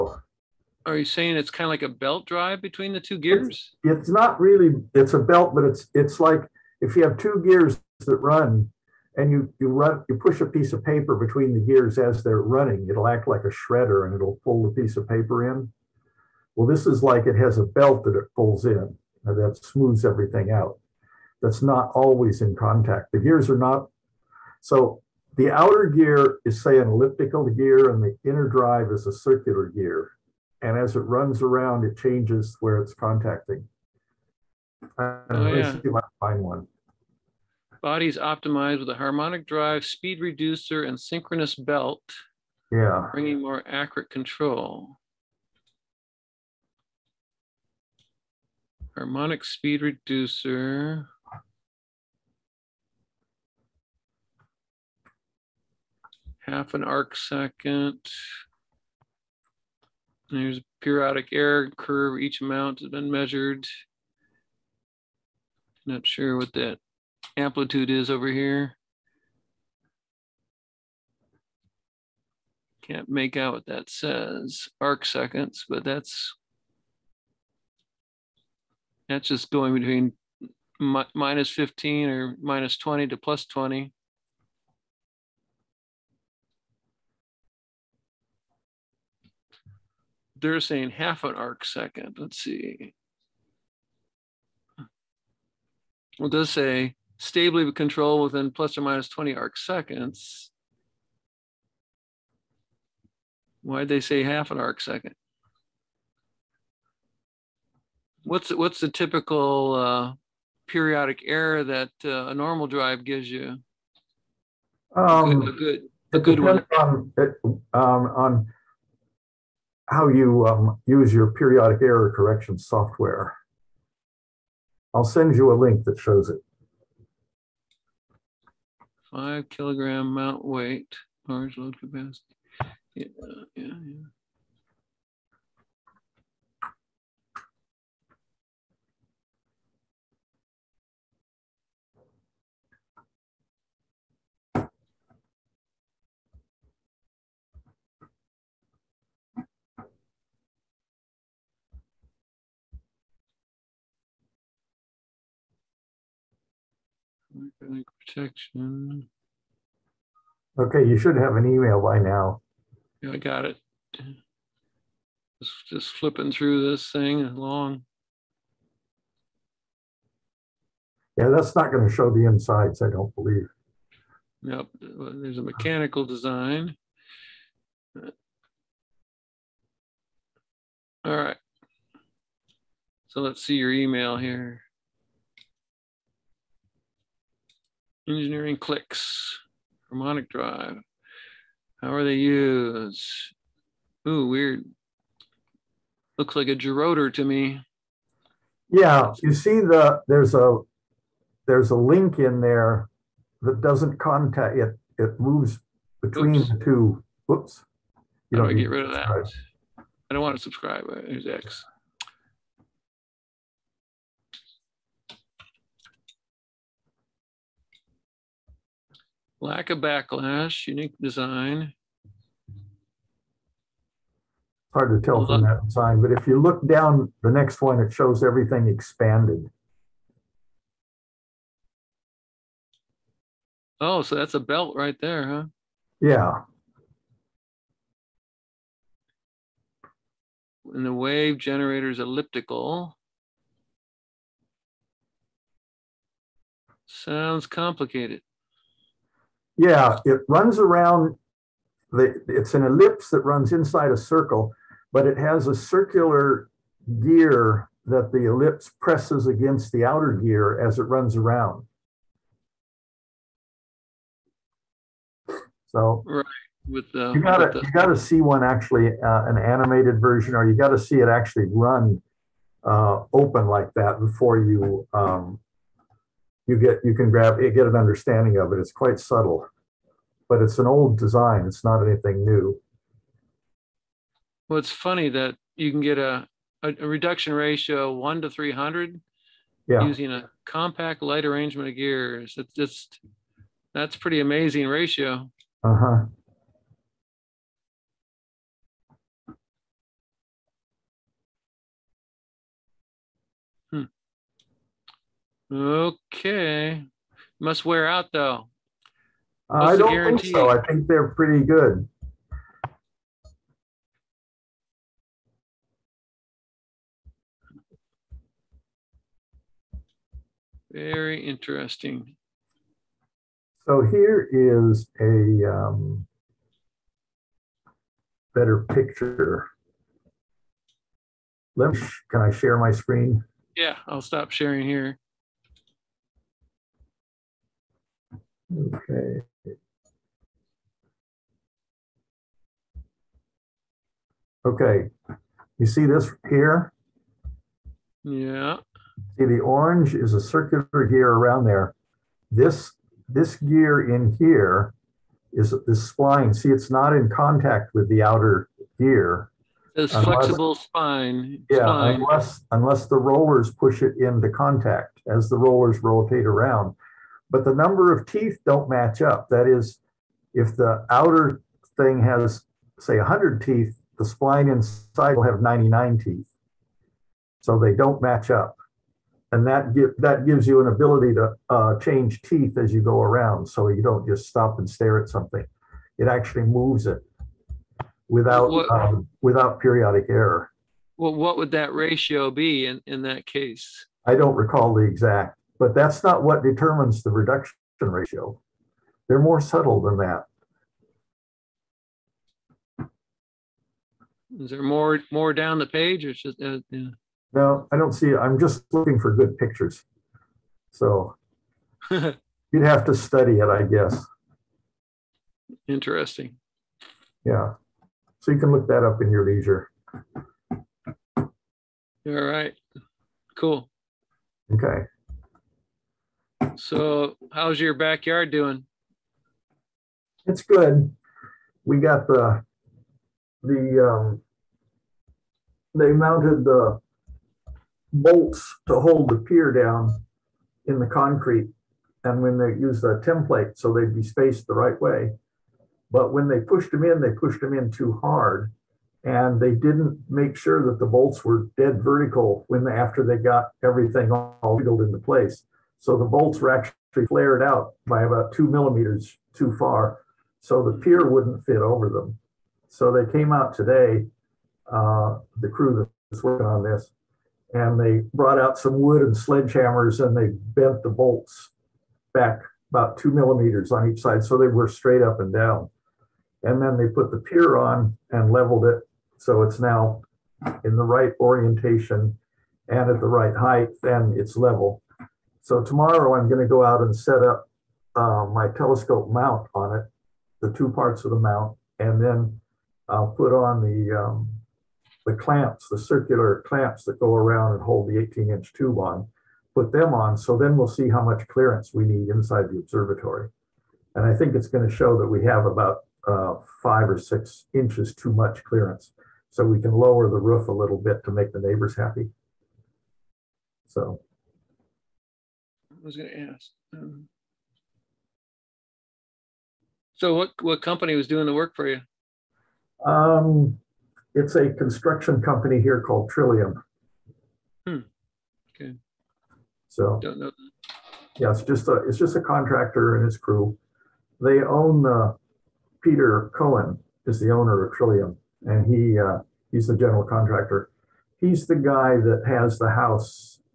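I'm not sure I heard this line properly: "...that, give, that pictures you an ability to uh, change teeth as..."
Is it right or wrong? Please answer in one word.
wrong.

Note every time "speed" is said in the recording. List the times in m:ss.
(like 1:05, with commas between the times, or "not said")
0:39, 0:49.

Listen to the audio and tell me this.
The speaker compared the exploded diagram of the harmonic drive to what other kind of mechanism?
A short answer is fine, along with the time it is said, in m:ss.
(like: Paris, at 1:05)
gerotor, at 3:16.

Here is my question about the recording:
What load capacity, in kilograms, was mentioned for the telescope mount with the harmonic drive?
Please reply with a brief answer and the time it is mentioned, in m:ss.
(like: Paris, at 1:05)
5 kilograms, at 2:09.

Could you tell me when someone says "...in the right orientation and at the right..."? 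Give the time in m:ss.
8:00.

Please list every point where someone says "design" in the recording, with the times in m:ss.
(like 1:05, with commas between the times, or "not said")
2:56, 3:41, 4:40.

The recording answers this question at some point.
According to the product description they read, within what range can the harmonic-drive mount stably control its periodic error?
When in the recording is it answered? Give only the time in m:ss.
1:38.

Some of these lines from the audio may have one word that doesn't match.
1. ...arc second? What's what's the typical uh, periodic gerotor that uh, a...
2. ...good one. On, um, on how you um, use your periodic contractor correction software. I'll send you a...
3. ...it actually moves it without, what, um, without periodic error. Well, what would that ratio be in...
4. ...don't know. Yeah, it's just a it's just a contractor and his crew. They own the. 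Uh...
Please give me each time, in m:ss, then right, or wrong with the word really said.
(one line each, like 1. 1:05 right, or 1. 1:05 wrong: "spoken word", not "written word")
1. 1:44 wrong: "error", not "gerotor"
2. 1:56 wrong: "error", not "contractor"
3. 6:25 right
4. 8:50 right.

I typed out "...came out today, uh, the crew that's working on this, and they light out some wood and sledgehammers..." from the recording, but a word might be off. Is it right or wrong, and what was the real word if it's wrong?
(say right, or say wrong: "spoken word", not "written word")
wrong: "brought", not "light".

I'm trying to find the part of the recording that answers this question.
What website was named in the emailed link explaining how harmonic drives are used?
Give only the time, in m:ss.
3:08.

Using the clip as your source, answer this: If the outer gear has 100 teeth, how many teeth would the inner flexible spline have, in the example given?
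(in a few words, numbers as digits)
99.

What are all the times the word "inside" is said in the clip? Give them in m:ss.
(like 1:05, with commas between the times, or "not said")
2:52, 4:13, 6:14, 8:22.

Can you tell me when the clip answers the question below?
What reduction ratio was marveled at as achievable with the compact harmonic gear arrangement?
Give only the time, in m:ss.
4:47.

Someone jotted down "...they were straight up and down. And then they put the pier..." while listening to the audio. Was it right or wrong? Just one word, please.
right.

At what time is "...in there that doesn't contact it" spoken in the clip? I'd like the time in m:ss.
3:22.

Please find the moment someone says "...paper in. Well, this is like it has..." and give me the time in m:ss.
0:15.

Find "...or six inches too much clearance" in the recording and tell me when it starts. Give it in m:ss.
8:26.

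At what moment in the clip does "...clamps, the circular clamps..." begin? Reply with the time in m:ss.
8:15.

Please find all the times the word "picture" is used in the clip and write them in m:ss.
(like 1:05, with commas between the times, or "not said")
5:28, 6:49.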